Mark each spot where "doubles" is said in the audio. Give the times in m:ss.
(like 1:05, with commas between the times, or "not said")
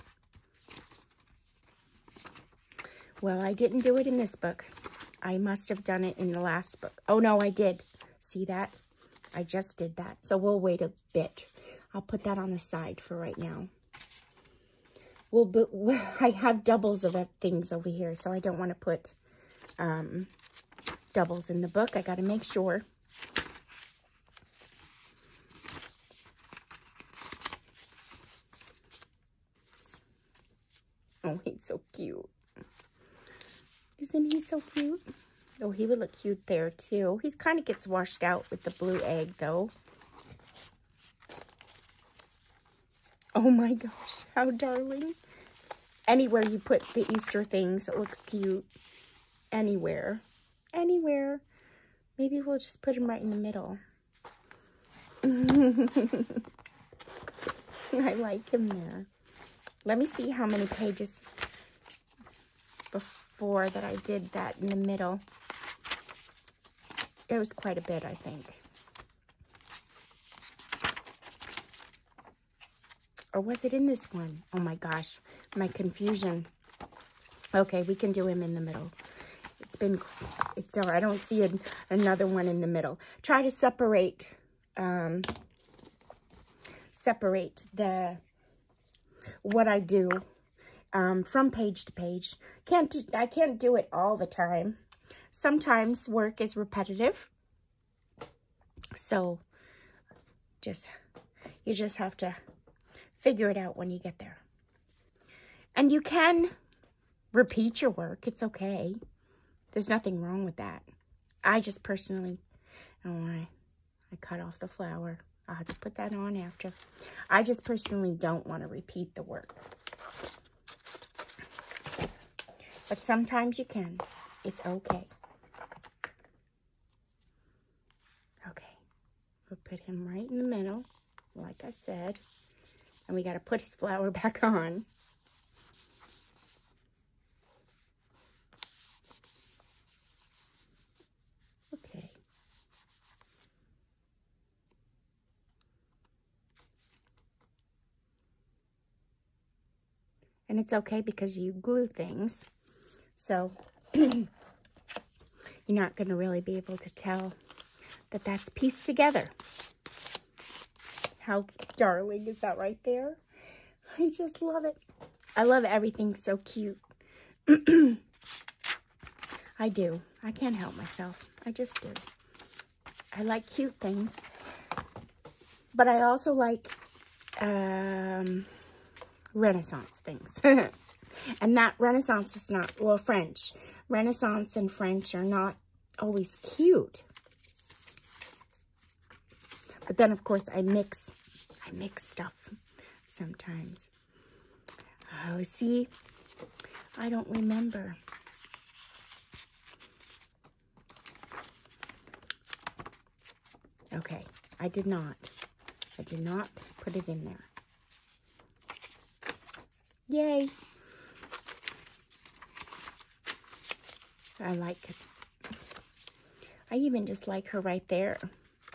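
0:16, 0:21.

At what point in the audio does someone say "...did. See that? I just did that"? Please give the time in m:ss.
0:07.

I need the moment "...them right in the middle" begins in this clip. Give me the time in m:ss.
0:52.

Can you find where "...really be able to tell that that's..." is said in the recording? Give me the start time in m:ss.
2:36.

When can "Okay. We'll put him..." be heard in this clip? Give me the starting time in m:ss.
2:08.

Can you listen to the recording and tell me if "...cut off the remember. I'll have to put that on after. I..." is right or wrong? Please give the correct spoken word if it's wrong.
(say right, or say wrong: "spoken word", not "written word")
wrong: "flower", not "remember".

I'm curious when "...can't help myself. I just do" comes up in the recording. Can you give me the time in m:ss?
2:50.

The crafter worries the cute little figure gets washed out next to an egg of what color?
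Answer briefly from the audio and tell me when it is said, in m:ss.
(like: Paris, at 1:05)
blue, at 0:38.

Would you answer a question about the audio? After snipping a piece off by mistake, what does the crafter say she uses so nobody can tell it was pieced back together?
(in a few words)
glue.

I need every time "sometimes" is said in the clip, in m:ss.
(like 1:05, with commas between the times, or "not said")
1:35, 2:02, 3:13.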